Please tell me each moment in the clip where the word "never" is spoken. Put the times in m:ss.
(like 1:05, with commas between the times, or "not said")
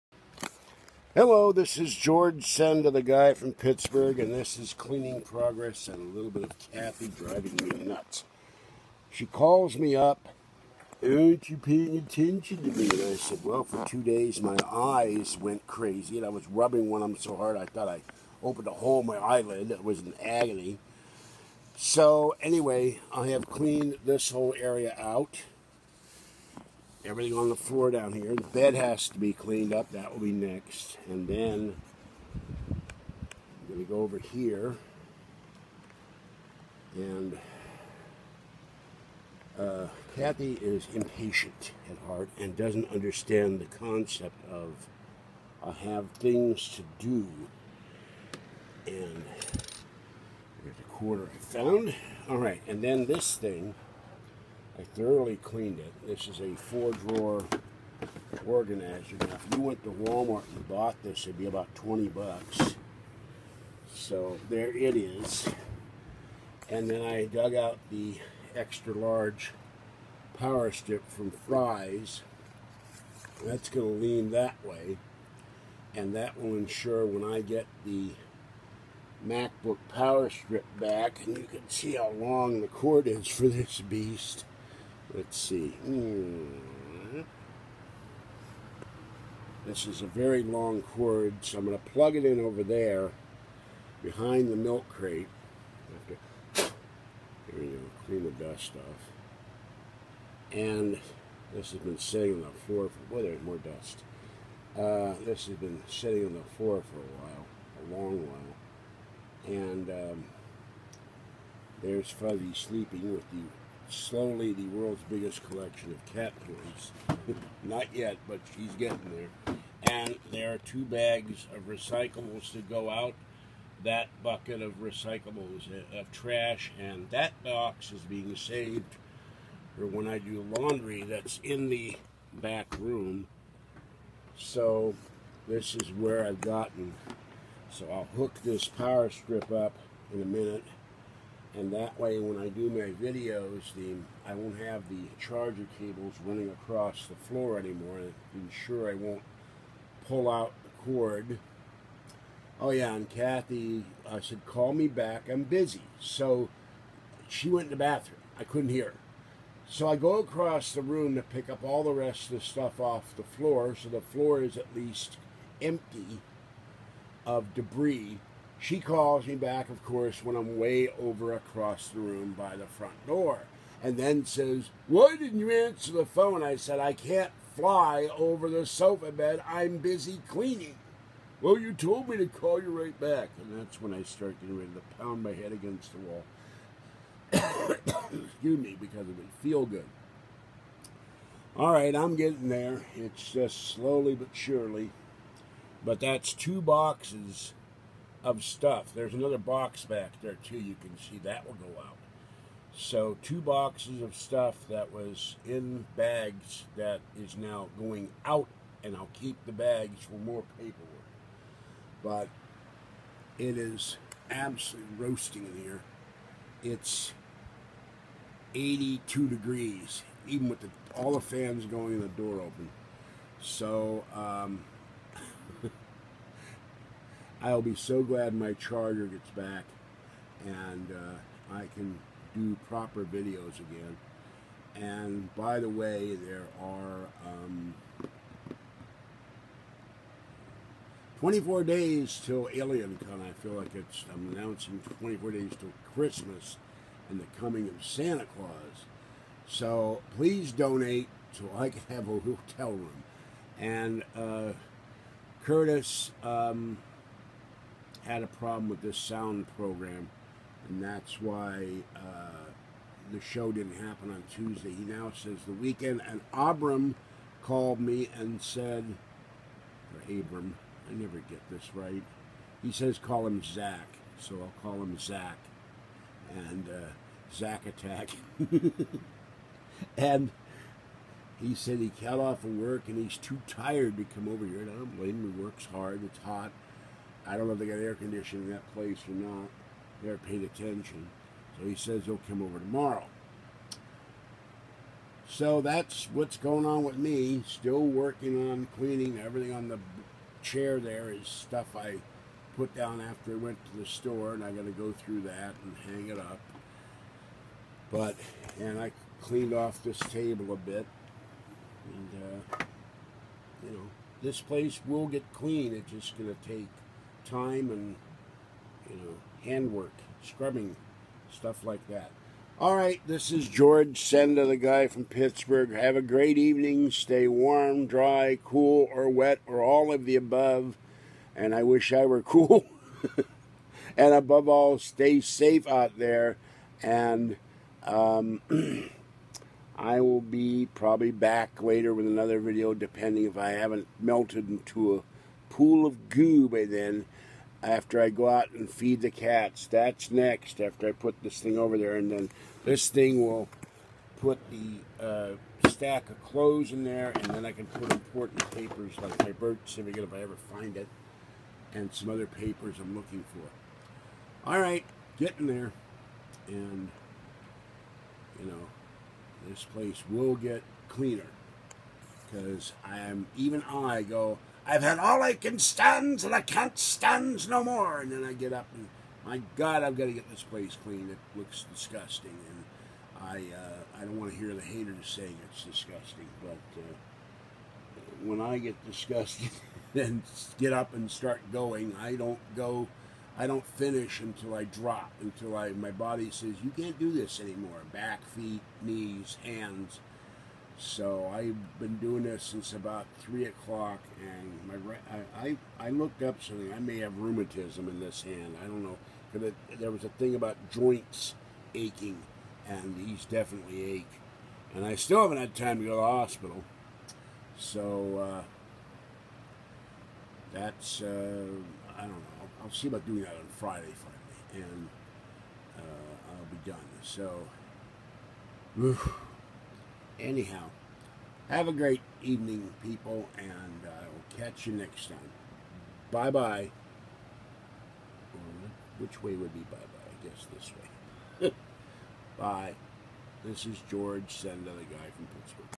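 4:30.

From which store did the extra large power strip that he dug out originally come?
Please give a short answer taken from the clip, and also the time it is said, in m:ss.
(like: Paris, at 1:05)
Fry's, at 1:11.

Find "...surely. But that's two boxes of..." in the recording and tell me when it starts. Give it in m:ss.
3:14.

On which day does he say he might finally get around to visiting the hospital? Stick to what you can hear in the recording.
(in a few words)
Friday.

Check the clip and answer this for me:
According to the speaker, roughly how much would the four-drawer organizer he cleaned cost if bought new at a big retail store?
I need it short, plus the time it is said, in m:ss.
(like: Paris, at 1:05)
$20, at 1:01.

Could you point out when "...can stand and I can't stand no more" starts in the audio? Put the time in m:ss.
6:15.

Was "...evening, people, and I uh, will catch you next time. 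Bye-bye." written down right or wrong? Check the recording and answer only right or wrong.
right.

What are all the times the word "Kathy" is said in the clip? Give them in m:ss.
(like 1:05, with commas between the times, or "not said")
0:06, 0:40, 2:33.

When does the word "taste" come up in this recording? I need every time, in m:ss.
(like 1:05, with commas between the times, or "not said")
not said.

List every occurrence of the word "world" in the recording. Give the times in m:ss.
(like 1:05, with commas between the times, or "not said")
1:54.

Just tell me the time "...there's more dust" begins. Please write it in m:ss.
1:43.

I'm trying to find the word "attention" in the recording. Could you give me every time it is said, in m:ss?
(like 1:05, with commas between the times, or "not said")
0:11, 4:50.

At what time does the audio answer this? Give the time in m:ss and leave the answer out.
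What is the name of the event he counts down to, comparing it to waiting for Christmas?
4:02.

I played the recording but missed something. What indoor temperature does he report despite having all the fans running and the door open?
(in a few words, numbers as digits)
82 degrees.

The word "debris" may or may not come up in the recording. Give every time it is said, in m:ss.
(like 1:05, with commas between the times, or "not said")
2:47.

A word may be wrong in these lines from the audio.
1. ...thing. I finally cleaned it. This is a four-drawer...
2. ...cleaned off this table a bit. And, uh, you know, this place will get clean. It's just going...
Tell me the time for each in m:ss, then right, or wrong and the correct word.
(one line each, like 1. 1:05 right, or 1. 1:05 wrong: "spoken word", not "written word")
1. 0:53 wrong: "thoroughly", not "finally"
2. 5:09 right.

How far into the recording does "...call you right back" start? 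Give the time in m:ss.
3:02.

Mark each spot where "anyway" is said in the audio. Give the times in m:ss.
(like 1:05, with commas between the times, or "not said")
0:22.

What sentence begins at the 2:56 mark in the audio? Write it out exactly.
I said, I can't fly over the sofa bed.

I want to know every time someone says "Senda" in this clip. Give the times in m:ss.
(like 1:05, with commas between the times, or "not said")
0:02, 5:24, 7:24.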